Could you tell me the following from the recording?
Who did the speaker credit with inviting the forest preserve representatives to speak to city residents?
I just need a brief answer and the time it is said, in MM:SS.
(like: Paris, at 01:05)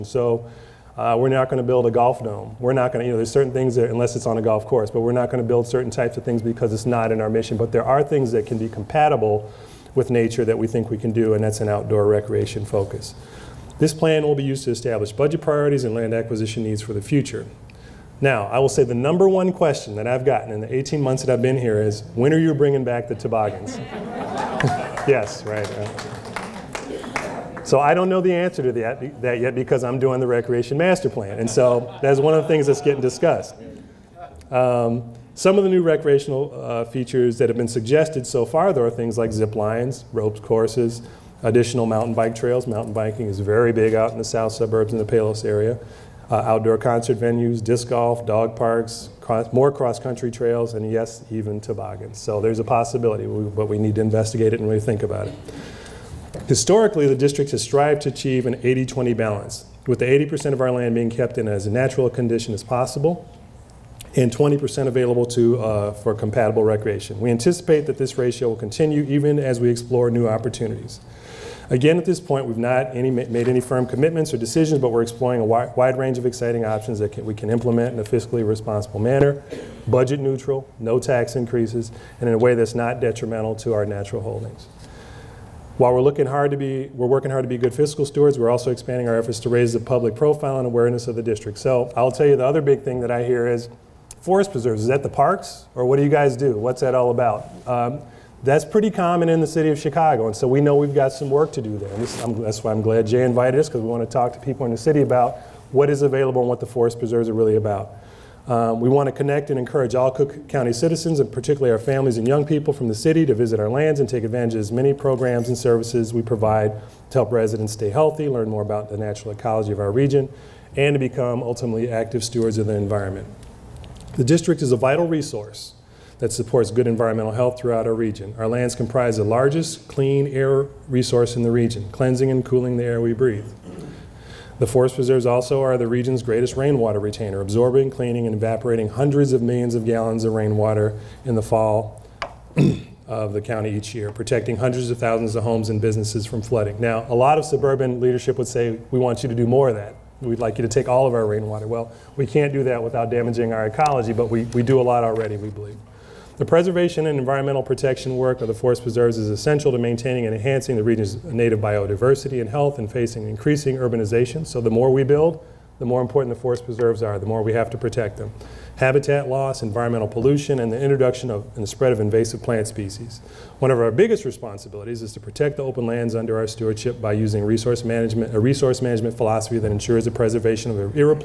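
Jay, at 01:43.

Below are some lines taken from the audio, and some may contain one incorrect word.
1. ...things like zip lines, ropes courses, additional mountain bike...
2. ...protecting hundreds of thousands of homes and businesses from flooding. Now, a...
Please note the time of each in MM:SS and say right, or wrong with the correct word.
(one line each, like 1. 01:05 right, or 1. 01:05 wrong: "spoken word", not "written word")
1. 00:38 right
2. 02:24 right.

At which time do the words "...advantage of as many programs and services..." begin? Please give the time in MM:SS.
01:54.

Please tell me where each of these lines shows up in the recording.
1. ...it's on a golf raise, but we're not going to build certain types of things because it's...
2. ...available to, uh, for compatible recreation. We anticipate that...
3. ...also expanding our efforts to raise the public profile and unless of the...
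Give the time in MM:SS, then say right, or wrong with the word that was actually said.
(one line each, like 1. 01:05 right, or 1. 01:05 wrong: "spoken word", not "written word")
1. 00:04 wrong: "course", not "raise"
2. 01:04 right
3. 01:28 wrong: "awareness", not "unless".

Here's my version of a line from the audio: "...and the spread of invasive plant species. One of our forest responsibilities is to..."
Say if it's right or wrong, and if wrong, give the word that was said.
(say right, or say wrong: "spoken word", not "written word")
wrong: "biggest", not "forest".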